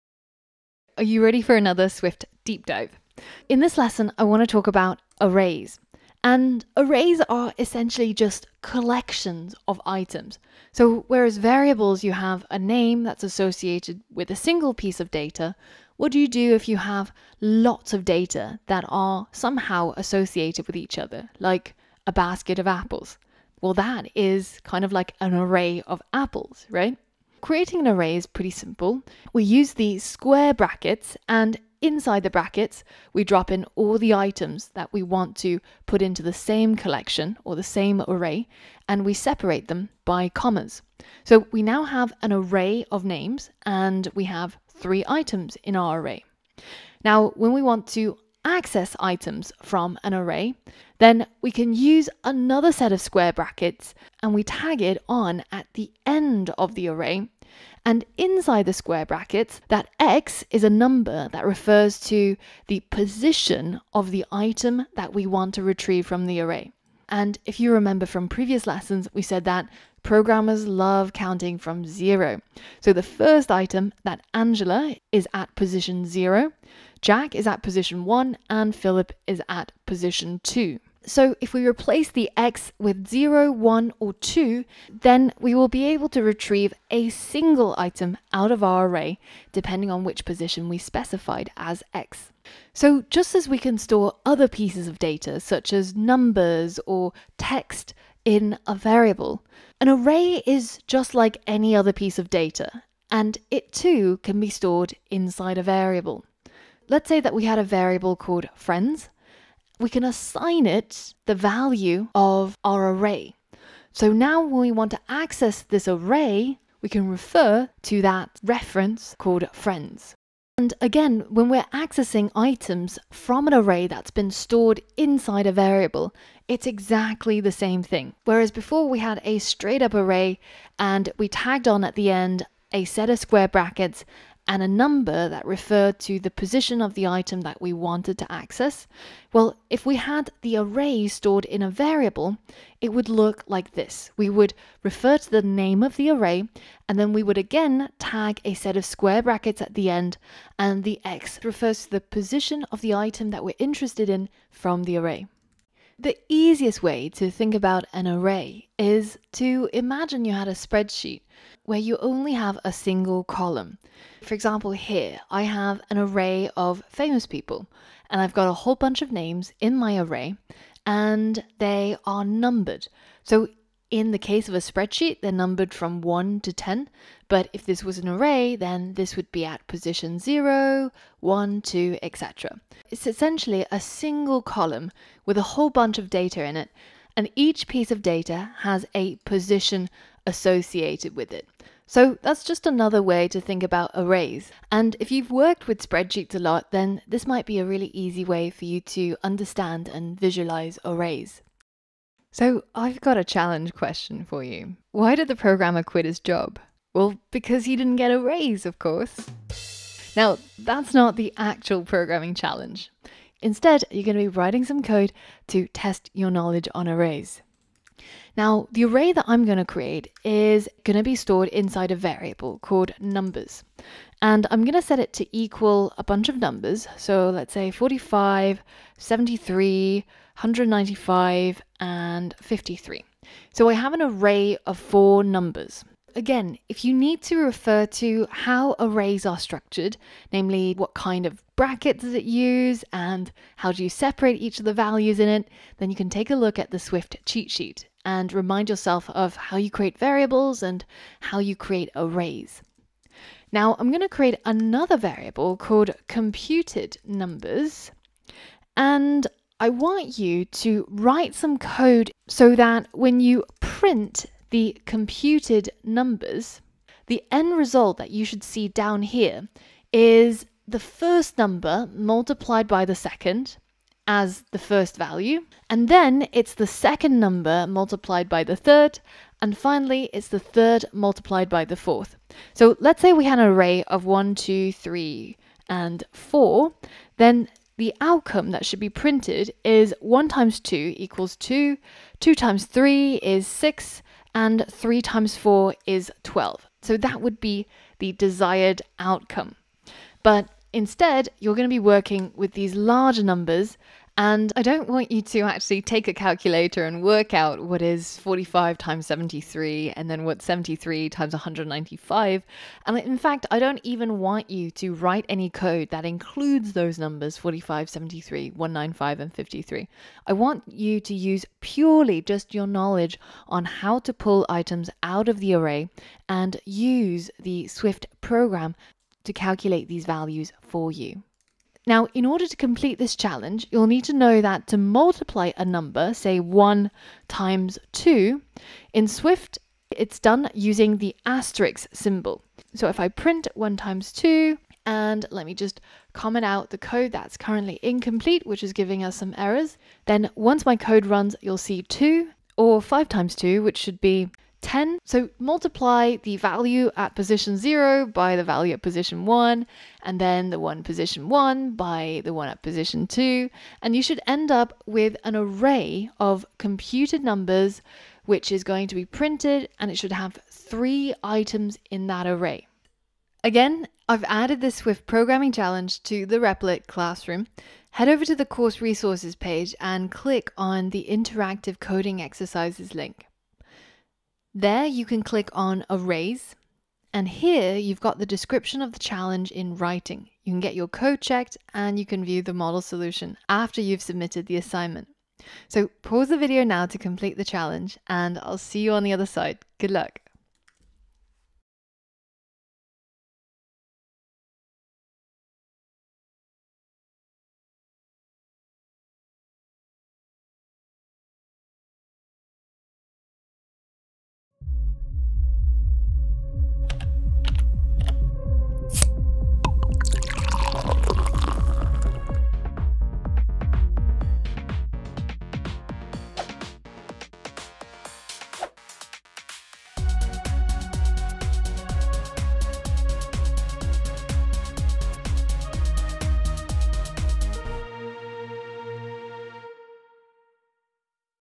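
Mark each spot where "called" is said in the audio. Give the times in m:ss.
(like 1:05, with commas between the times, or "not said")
1:48, 1:59, 3:42, 4:15.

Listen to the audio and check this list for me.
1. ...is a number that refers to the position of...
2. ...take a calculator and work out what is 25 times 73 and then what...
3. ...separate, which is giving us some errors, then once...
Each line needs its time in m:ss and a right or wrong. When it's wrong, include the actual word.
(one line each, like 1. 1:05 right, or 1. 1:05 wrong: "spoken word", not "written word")
1. 1:00 right
2. 5:05 wrong: "45", not "25"
3. 5:47 wrong: "incomplete", not "separate".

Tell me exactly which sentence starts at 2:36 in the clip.
The easiest way to think about an array is to imagine you had a spreadsheet where you only have a single column.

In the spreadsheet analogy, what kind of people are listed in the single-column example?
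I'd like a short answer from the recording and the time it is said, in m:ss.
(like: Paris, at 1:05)
famous people, at 2:46.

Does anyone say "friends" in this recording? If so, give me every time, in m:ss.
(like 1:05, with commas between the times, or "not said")
1:48, 1:59.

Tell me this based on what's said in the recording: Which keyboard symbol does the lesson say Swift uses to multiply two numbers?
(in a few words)
asterisk.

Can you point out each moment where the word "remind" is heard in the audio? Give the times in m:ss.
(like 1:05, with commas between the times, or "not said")
4:08.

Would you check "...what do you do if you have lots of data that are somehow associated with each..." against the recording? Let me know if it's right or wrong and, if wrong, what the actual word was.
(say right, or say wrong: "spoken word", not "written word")
right.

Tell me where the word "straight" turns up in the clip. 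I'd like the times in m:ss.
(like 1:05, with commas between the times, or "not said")
2:09.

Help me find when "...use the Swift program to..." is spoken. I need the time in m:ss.
5:26.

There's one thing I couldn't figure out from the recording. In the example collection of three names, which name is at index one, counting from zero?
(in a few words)
Jack.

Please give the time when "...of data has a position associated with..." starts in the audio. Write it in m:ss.
3:07.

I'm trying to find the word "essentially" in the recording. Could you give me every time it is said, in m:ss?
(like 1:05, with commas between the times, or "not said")
0:07, 3:03.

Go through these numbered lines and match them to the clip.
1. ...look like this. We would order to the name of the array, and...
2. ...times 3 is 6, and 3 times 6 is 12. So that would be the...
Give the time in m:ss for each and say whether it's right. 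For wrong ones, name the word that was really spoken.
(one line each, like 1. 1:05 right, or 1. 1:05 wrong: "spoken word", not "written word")
1. 2:23 wrong: "refer", not "order"
2. 4:52 wrong: "4", not "6".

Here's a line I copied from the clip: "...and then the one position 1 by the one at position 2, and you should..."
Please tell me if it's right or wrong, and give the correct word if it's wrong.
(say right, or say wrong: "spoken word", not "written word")
right.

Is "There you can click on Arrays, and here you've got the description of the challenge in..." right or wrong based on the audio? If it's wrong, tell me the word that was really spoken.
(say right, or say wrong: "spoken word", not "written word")
right.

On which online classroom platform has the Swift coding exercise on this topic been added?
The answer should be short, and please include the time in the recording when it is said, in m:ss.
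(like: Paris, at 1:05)
Replit, at 6:16.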